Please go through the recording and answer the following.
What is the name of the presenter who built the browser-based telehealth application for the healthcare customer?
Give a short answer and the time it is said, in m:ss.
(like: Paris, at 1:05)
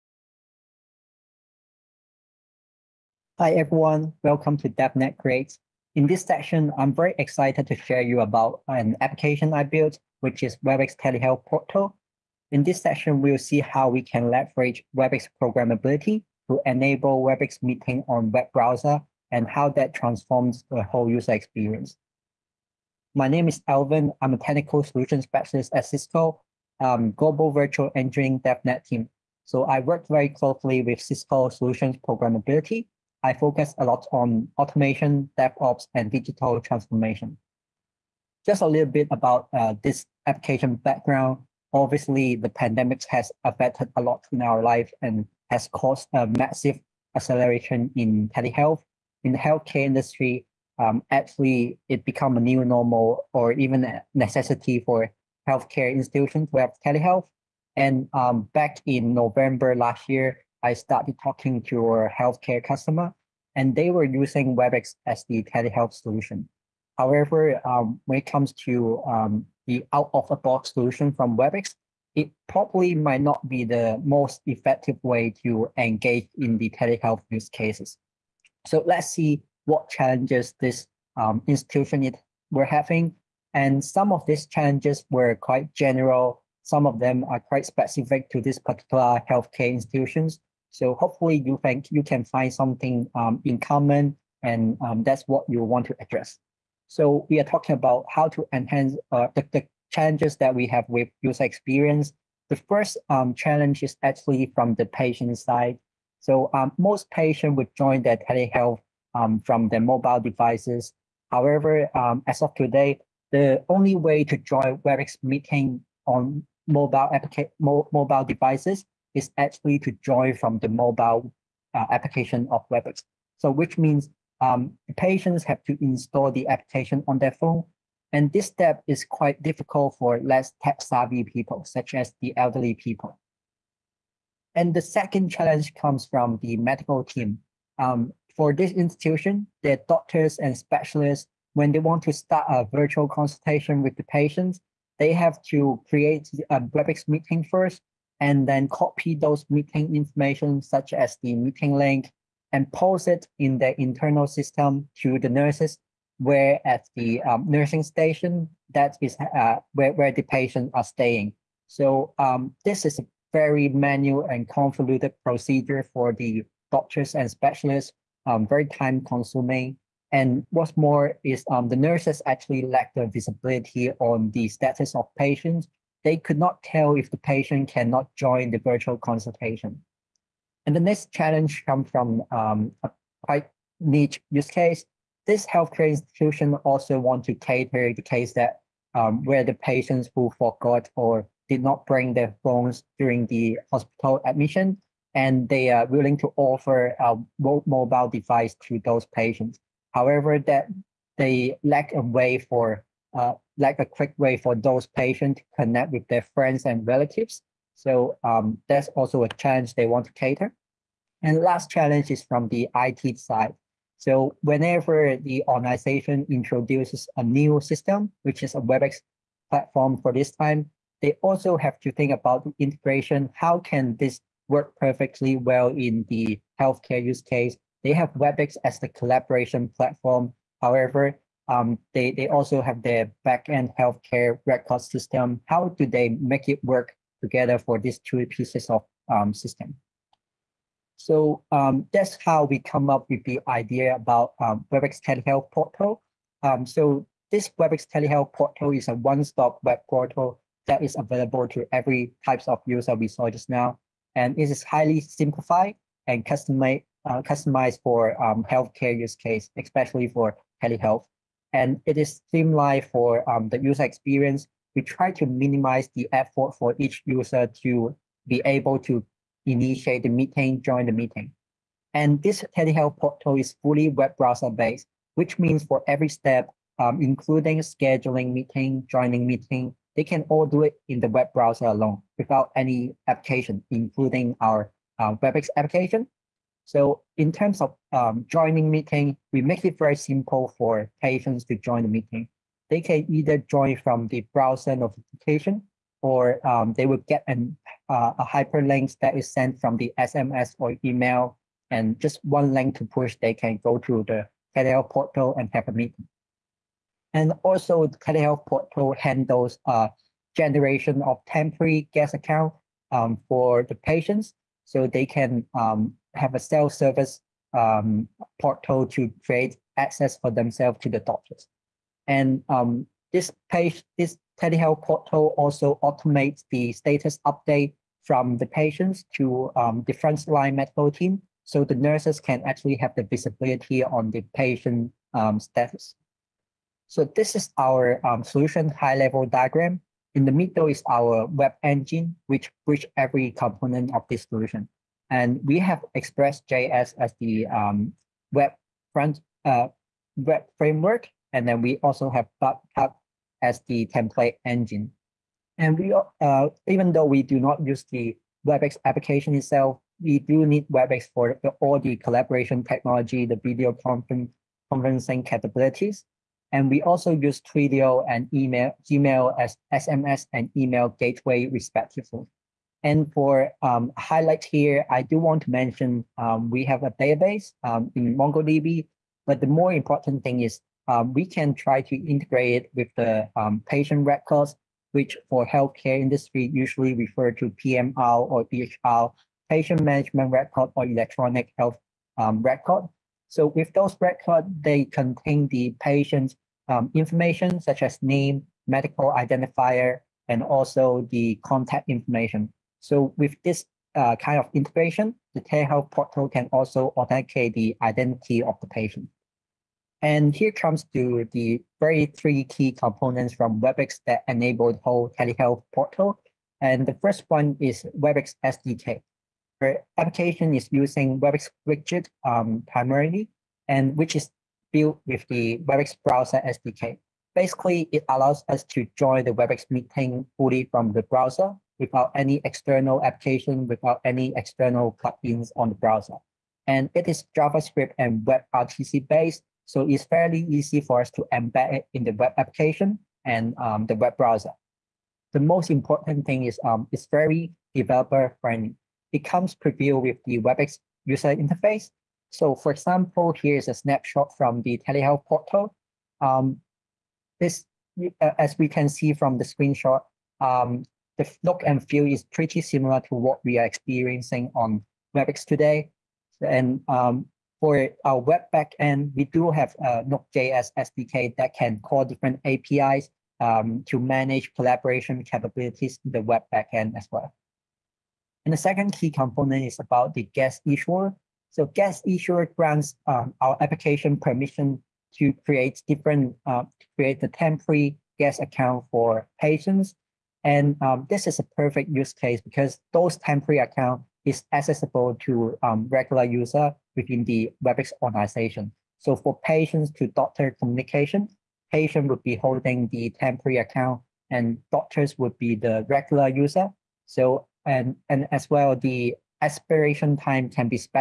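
Alvin, at 0:23.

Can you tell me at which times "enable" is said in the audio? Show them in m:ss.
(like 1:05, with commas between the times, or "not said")
0:16, 6:54.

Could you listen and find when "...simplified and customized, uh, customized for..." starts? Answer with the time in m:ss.
4:14.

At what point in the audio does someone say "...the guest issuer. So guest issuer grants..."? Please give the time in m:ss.
8:00.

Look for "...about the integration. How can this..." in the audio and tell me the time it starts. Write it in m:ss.
3:42.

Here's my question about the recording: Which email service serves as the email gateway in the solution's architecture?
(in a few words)
Gmail.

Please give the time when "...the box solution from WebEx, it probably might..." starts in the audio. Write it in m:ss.
1:10.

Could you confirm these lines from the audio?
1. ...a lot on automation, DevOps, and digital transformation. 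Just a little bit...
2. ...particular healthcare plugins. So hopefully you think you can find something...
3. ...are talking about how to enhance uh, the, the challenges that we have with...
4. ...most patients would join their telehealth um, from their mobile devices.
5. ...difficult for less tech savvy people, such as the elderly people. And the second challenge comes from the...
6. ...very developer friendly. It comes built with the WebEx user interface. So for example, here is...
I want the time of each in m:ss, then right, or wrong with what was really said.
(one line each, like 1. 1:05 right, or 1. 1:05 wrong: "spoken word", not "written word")
1. 0:33 right
2. 1:28 wrong: "institutions", not "plugins"
3. 1:37 right
4. 1:46 right
5. 2:09 right
6. 7:27 wrong: "prebuilt", not "built".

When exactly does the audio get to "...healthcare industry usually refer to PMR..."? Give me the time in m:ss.
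6:25.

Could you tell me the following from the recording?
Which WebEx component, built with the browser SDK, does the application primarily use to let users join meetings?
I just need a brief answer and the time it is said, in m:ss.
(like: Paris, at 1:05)
WebEx widget, at 7:01.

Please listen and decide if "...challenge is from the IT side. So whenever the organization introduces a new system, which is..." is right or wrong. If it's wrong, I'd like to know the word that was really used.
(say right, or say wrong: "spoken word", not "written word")
right.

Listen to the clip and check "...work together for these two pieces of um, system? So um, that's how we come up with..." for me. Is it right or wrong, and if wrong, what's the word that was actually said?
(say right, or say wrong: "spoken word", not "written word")
right.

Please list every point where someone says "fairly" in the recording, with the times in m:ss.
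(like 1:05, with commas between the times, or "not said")
7:20.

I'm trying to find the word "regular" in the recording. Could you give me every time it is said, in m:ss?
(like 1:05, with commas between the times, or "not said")
8:15, 8:25.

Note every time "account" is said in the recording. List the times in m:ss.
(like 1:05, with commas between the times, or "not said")
5:12, 8:08, 8:13, 8:23.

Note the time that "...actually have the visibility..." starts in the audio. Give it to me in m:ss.
5:32.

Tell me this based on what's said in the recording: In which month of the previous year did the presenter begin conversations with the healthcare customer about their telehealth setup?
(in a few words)
November.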